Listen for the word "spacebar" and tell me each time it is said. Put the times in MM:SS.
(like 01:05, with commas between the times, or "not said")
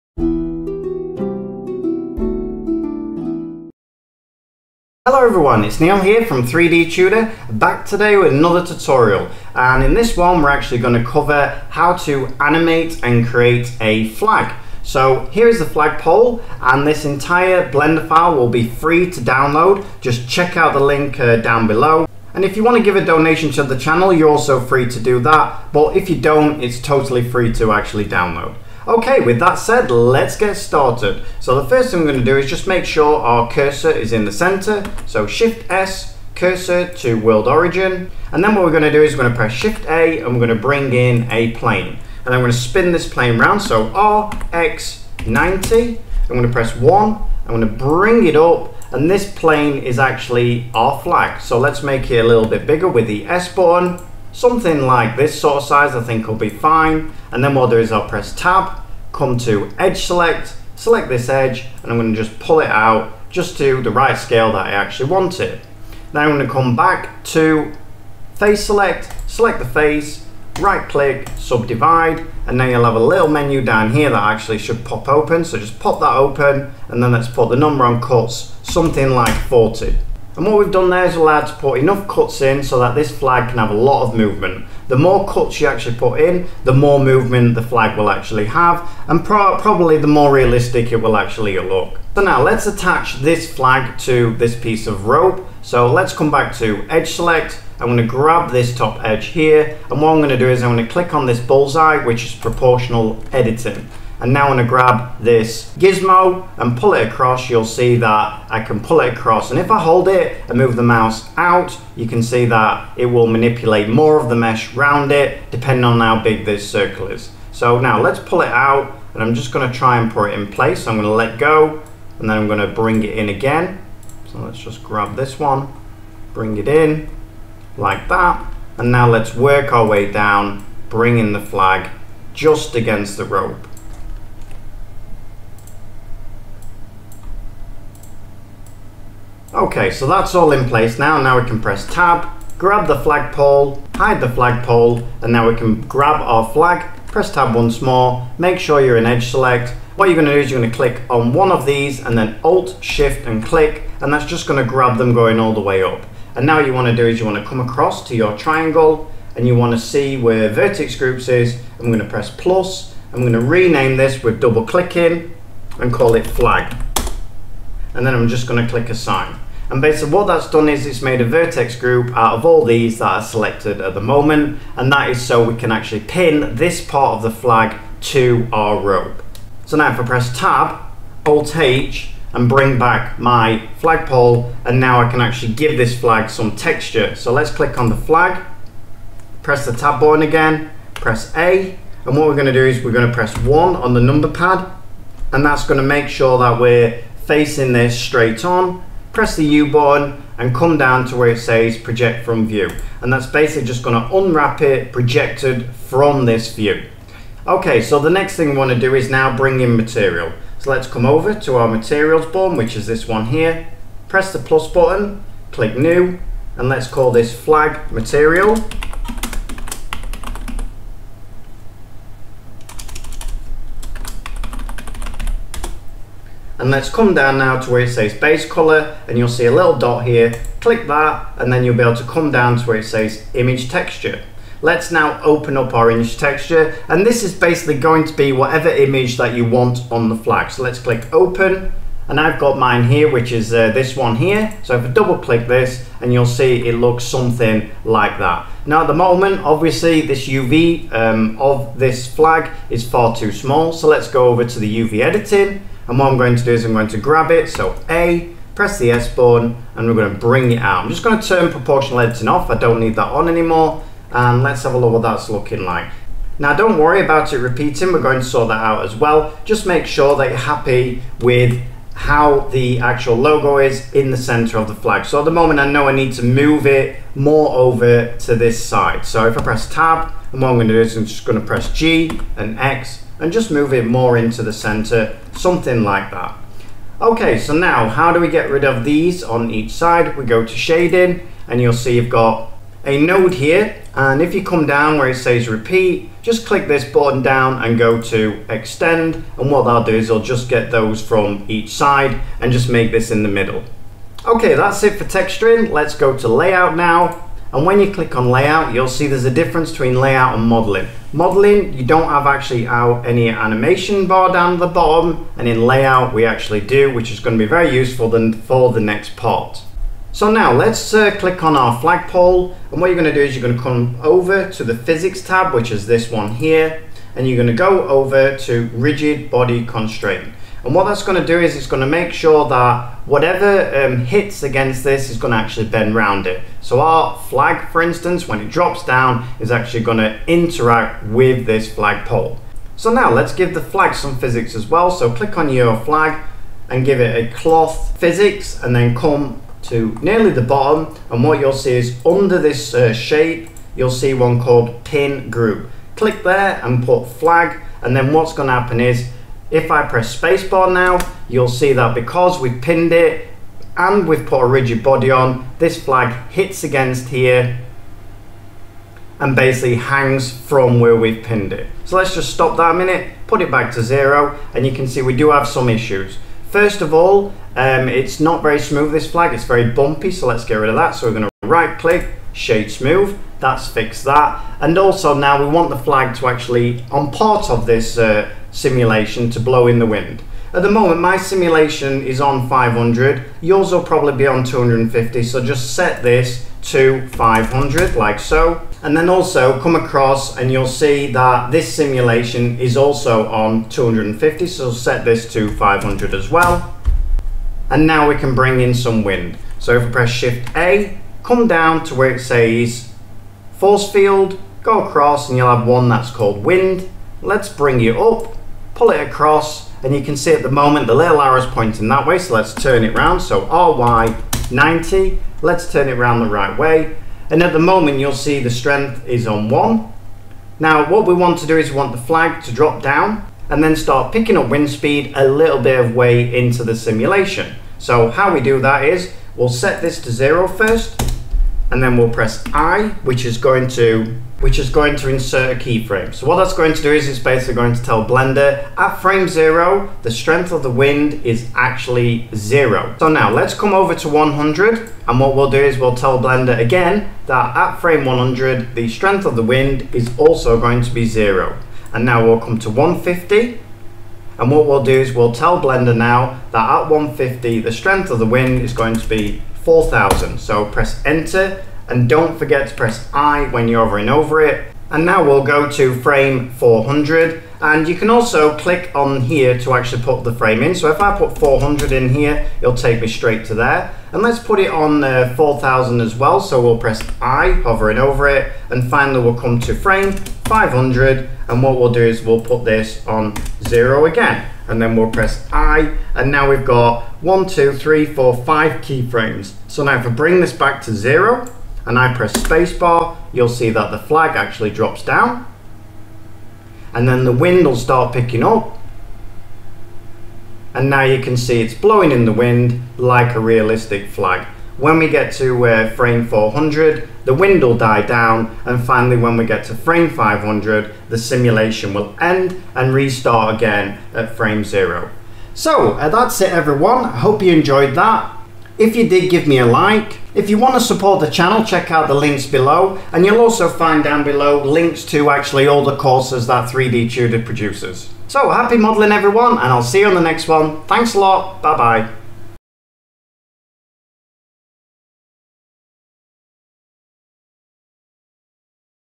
06:00, 08:22.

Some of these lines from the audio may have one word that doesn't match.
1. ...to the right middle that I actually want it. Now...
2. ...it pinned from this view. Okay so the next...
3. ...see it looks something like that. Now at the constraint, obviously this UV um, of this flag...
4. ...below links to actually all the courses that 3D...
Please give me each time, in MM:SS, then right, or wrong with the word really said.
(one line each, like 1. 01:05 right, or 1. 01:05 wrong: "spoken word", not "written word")
1. 01:03 wrong: "scale", not "middle"
2. 03:24 wrong: "projected", not "pinned"
3. 04:06 wrong: "moment", not "constraint"
4. 08:54 right.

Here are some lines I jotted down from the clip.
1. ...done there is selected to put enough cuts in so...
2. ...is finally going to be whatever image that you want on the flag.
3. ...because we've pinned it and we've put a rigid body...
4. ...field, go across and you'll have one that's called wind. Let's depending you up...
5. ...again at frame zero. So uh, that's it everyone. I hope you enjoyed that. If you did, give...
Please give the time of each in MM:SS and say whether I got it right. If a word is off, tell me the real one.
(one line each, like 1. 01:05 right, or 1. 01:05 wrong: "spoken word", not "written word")
1. 01:20 wrong: "allowed", not "selected"
2. 03:57 wrong: "basically", not "finally"
3. 06:01 right
4. 06:53 wrong: "bring", not "depending"
5. 08:43 right.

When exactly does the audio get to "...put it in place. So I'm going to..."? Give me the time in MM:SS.
02:00.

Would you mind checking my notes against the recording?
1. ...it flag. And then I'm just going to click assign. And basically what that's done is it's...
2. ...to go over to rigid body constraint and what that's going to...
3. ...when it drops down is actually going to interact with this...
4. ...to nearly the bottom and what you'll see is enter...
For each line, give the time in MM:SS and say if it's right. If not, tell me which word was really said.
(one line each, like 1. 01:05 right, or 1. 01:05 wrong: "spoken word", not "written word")
1. 02:46 right
2. 05:27 right
3. 05:38 right
4. 05:49 wrong: "under", not "enter".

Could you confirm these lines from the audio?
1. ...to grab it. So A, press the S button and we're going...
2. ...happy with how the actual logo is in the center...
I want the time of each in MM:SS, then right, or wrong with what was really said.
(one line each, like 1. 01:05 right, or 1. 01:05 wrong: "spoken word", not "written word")
1. 04:16 right
2. 04:30 right.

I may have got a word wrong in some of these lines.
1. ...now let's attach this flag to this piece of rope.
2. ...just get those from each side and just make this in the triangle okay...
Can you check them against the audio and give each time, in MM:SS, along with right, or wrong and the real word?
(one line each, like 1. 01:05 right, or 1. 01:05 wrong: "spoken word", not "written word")
1. 01:32 right
2. 05:00 wrong: "middle", not "triangle".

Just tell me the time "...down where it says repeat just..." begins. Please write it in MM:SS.
04:54.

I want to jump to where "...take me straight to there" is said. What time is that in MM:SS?
08:02.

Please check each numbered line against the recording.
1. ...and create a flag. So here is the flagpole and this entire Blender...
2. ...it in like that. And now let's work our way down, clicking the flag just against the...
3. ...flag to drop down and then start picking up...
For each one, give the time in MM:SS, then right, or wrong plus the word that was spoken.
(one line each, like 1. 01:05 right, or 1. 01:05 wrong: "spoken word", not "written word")
1. 00:13 right
2. 02:06 wrong: "bringing", not "clicking"
3. 07:11 right.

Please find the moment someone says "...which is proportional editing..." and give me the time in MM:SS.
01:42.